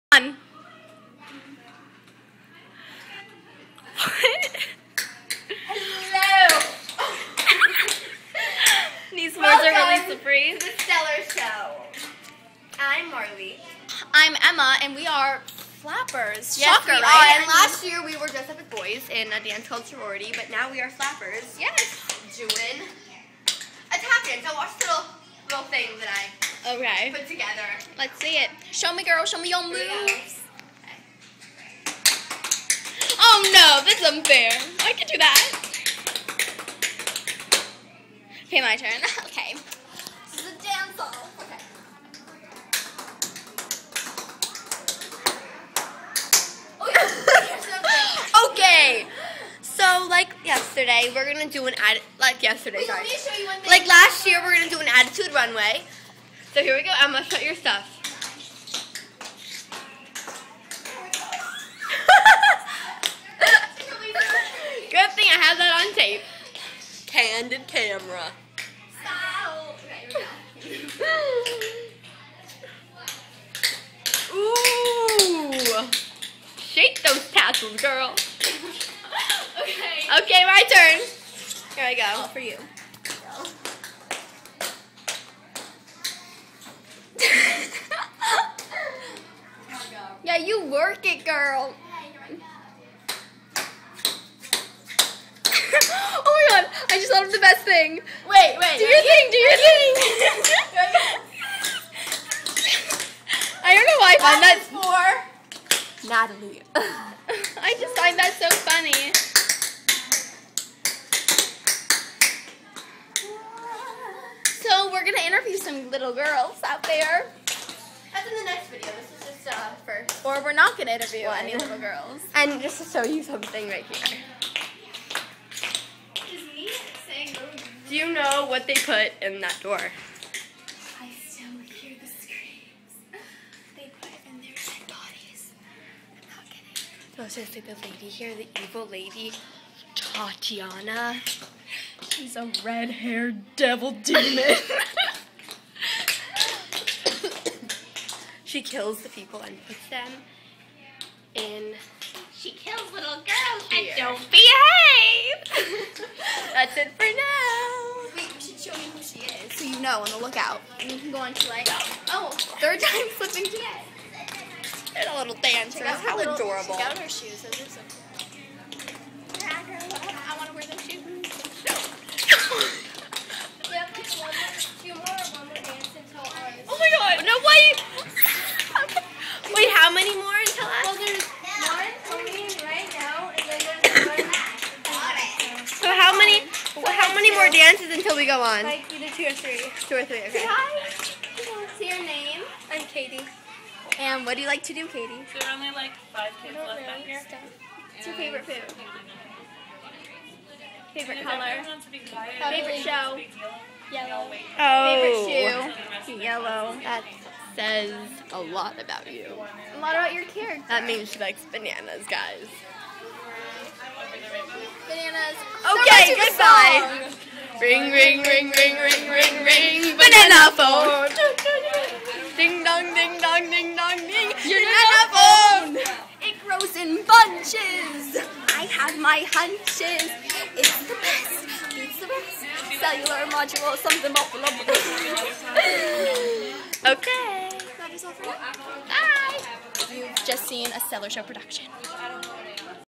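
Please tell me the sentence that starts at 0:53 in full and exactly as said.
Like last year, we're gonna do an attitude runway.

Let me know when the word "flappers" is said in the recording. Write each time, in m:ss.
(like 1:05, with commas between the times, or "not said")
0:15, 0:20.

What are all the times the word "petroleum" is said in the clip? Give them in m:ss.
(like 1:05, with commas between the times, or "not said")
not said.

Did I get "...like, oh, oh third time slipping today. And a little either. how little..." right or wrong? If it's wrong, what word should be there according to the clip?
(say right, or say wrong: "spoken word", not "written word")
wrong: "dancer", not "either".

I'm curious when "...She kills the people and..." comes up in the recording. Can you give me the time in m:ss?
2:28.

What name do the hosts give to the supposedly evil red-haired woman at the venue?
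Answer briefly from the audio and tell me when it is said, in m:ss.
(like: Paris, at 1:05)
Tatiana, at 2:19.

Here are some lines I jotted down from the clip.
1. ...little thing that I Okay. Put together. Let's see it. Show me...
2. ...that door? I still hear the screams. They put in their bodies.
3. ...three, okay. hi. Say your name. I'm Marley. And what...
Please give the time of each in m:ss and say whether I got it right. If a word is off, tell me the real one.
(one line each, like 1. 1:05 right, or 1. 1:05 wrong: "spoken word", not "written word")
1. 0:25 right
2. 2:09 right
3. 3:10 wrong: "Katie", not "Marley".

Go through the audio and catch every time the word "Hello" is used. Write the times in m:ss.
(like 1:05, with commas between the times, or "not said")
0:03.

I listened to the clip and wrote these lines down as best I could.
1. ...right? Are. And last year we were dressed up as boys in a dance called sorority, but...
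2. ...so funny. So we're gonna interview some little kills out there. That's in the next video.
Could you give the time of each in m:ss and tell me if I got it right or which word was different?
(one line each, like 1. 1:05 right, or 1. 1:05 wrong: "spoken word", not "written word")
1. 0:17 right
2. 1:48 wrong: "girls", not "kills".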